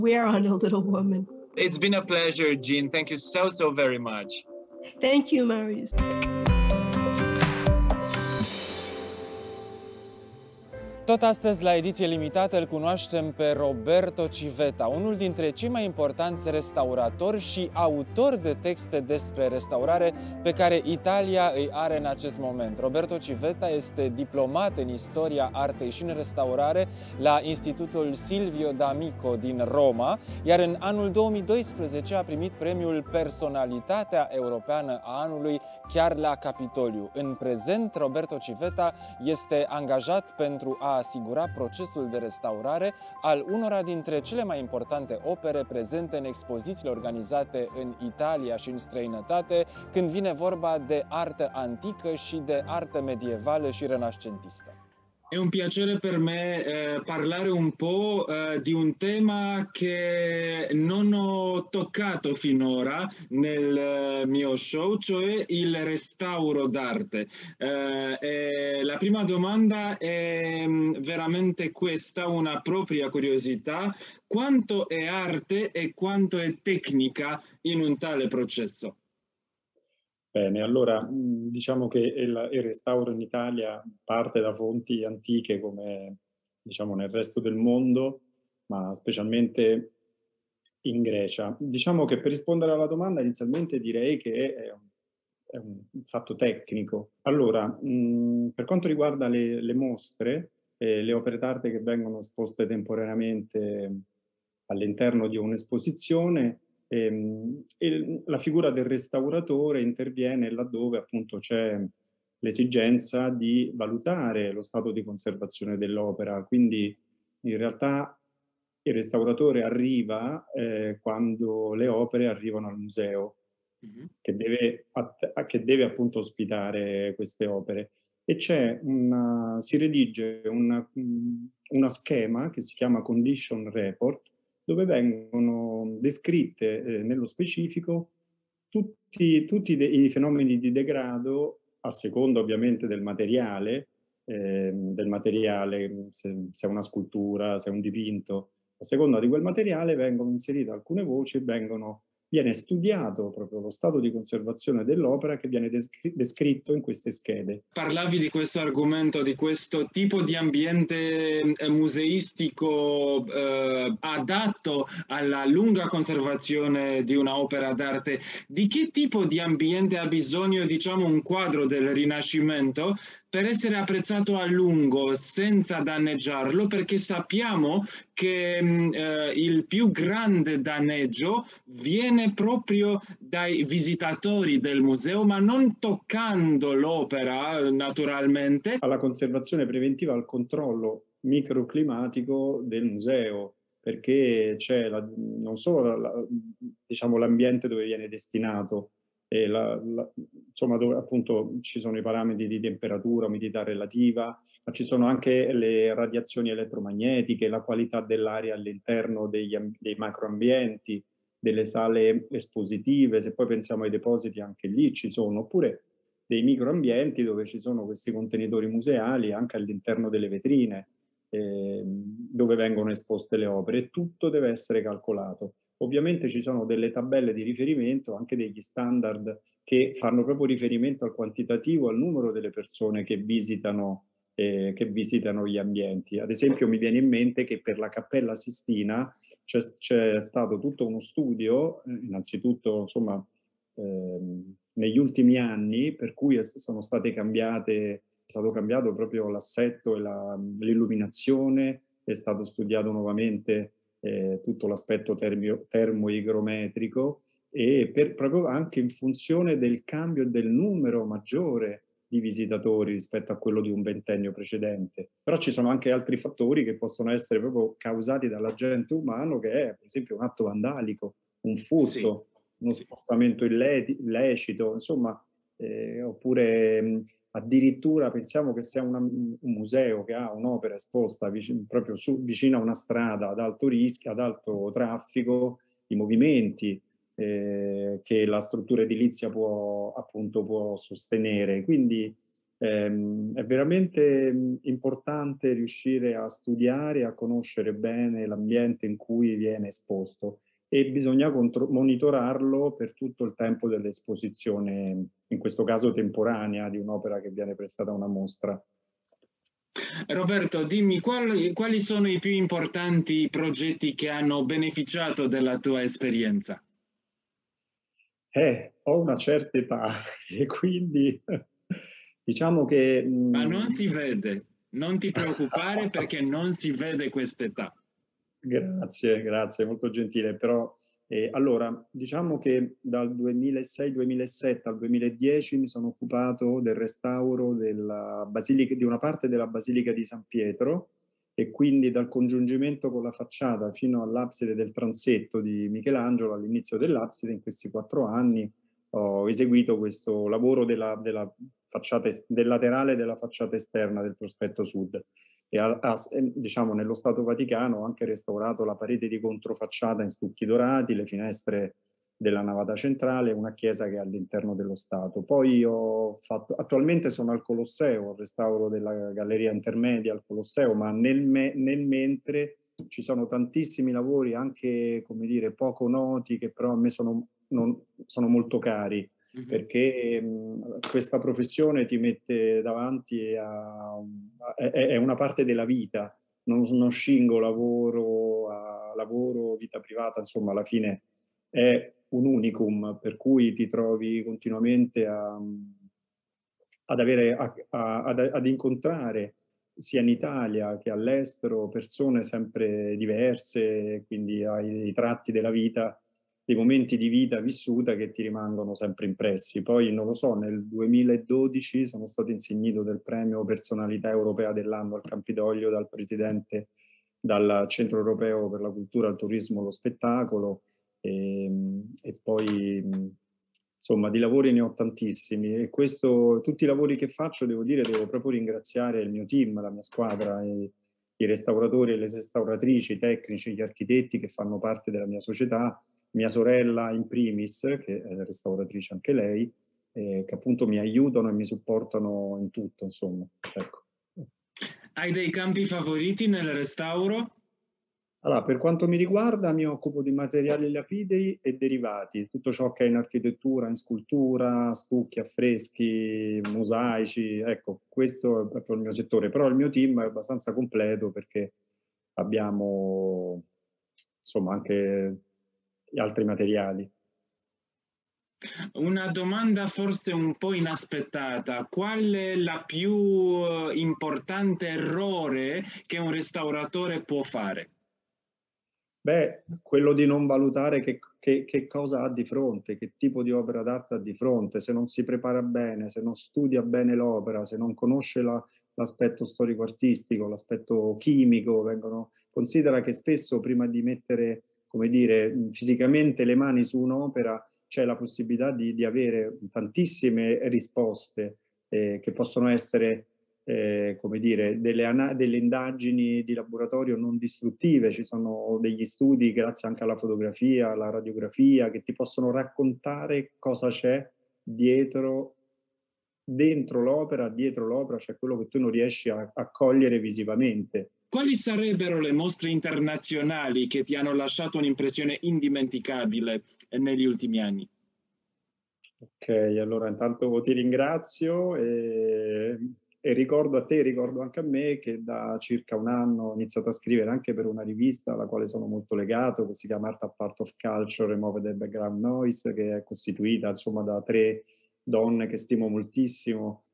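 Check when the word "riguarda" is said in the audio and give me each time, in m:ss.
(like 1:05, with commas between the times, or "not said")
1:38, 7:28.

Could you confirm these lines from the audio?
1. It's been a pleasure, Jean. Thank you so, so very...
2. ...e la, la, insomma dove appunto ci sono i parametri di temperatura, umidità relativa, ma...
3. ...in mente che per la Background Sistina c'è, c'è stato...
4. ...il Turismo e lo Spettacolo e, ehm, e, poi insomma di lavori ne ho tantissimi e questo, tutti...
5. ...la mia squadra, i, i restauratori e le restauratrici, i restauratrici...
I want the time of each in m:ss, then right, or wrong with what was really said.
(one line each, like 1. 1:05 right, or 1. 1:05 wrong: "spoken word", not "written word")
1. 0:01 right
2. 3:19 right
3. 3:56 wrong: "Cappella", not "Background"
4. 6:59 right
5. 7:09 wrong: "tecnici", not "restauratrici".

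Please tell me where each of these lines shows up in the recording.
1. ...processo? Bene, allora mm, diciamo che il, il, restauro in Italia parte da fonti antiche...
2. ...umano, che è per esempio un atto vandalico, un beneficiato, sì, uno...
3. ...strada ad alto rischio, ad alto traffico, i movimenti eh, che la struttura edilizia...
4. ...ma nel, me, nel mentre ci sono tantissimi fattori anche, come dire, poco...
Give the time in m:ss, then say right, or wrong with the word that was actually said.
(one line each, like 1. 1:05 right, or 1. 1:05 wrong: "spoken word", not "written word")
1. 1:18 right
2. 4:28 wrong: "furto", not "beneficiato"
3. 4:42 right
4. 6:10 wrong: "lavori", not "fattori".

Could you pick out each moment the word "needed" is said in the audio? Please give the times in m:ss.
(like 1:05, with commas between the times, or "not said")
not said.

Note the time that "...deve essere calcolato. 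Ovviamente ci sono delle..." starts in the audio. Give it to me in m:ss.
3:44.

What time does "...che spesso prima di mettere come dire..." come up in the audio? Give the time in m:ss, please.
8:12.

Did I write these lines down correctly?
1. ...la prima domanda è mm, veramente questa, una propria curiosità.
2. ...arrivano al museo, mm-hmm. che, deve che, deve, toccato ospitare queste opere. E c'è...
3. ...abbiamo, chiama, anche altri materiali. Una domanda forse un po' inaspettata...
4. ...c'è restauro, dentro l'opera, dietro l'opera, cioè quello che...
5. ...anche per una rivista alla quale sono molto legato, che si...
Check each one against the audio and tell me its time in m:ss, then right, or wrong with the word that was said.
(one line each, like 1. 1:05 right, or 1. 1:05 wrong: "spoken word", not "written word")
1. 1:08 right
2. 2:02 wrong: "appunto", not "toccato"
3. 7:42 wrong: "insomma", not "chiama"
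4. 8:33 wrong: "dietro", not "restauro"
5. 8:57 right.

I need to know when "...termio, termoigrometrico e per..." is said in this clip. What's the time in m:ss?
4:15.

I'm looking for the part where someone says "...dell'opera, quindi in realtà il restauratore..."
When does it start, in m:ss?
1:55.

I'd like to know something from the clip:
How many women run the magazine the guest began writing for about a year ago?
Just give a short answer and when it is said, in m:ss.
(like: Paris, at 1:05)
3, at 9:04.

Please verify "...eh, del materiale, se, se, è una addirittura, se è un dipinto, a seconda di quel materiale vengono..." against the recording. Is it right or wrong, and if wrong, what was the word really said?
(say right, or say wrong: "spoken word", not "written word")
wrong: "scultura", not "addirittura".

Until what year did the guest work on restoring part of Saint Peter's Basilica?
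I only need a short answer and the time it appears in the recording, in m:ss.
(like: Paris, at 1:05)
2010, at 5:34.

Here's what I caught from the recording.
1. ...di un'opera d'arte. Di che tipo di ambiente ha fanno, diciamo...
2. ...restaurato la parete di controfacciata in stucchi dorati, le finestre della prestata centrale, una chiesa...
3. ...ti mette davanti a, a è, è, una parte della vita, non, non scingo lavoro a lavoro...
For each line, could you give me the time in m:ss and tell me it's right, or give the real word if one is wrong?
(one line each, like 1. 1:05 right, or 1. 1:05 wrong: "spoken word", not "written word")
1. 2:47 wrong: "bisogno", not "fanno"
2. 5:58 wrong: "navata", not "prestata"
3. 6:21 right.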